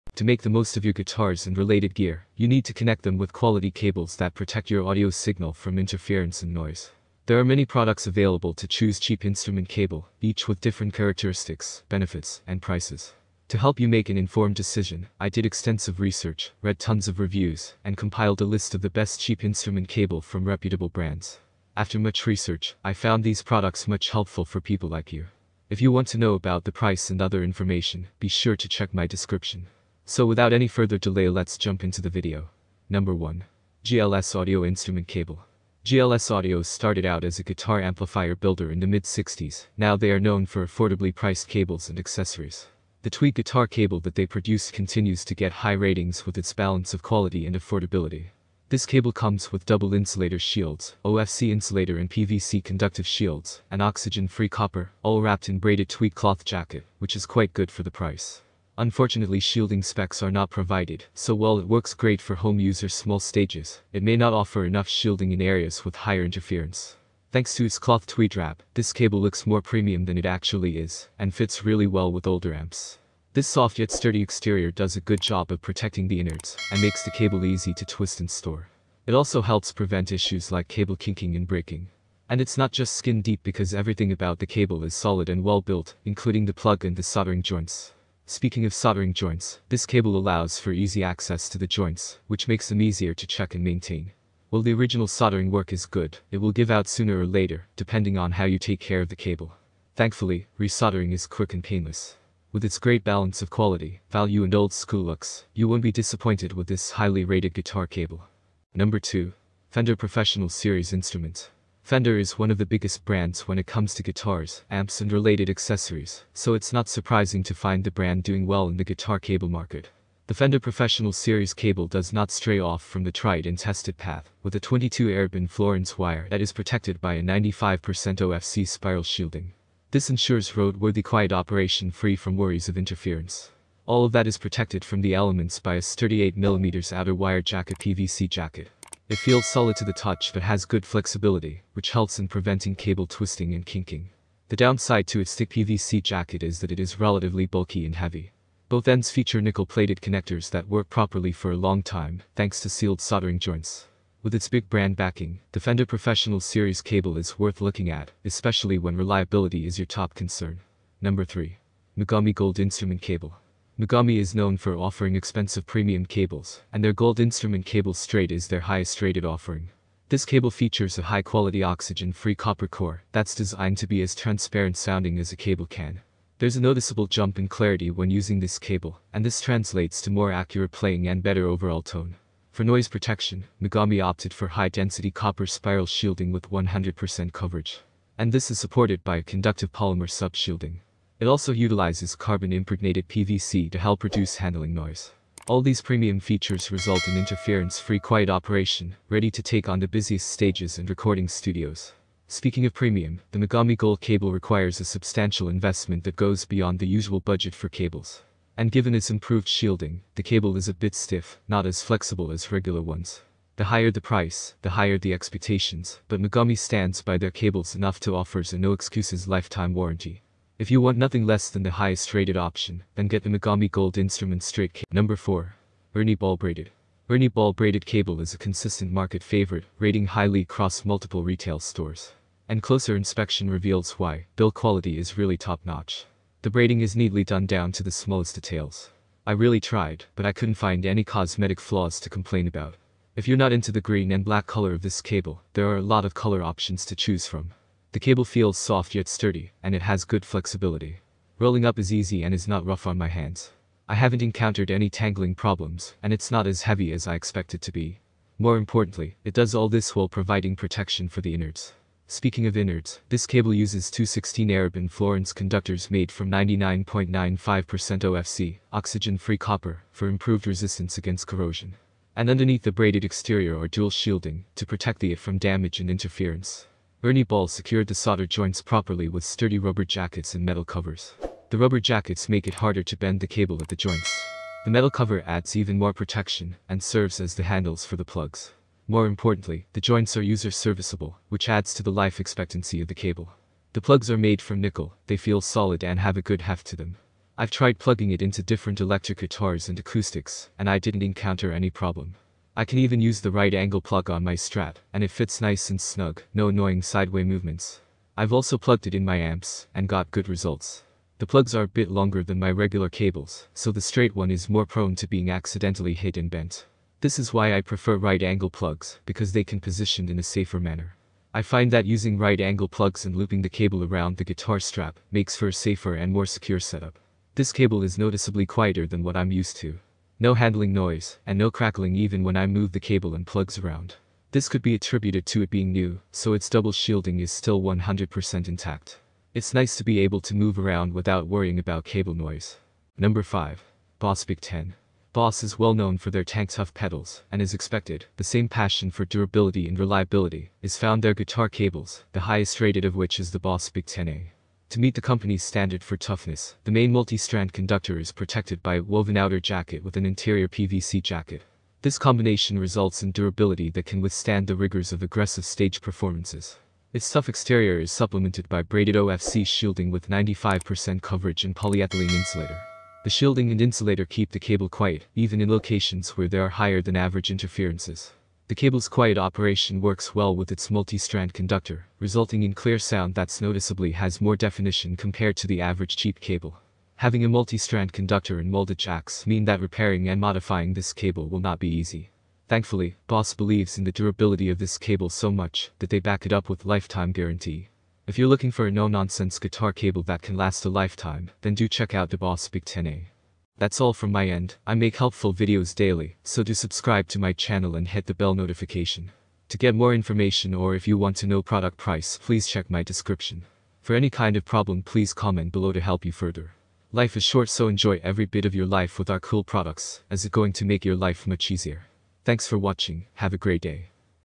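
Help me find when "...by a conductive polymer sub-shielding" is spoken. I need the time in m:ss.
3:09.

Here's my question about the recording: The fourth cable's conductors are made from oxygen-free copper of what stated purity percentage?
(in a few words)
99.95%.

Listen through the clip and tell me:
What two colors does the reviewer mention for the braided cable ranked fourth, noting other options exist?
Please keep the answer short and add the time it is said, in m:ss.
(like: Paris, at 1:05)
green and black, at 4:03.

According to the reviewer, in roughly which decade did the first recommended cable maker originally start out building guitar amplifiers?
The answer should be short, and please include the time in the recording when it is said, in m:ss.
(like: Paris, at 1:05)
mid-60s, at 0:38.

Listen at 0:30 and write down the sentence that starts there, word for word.
So without any further delay let's jump into the video.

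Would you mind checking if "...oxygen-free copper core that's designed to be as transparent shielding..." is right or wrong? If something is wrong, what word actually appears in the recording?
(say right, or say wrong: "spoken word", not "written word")
wrong: "sounding", not "shielding".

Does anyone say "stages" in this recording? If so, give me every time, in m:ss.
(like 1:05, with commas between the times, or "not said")
1:03, 3:20, 6:05.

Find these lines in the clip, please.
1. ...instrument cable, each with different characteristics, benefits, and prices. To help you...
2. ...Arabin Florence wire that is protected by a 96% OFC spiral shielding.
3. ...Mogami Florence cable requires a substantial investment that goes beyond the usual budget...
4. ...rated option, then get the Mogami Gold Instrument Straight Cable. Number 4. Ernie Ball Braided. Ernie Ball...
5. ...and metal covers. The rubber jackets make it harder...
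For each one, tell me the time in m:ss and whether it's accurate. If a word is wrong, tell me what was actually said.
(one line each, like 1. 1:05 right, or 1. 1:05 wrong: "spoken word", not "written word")
1. 0:09 right
2. 2:05 wrong: "95", not "96"
3. 3:23 wrong: "Gold", not "Florence"
4. 3:42 right
5. 4:40 right.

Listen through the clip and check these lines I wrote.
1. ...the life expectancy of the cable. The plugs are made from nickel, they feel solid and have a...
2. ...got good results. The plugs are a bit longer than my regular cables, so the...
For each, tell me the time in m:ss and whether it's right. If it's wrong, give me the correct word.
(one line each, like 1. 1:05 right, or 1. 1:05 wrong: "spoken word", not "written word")
1. 4:51 right
2. 5:09 right.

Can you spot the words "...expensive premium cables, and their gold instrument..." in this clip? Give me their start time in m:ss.
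2:45.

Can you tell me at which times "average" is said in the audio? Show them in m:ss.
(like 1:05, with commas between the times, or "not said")
6:16, 6:25.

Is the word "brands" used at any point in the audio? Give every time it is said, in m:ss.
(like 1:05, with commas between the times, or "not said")
0:20, 1:53, 1:57, 2:34.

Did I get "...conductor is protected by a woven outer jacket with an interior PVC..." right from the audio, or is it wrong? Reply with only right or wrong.
right.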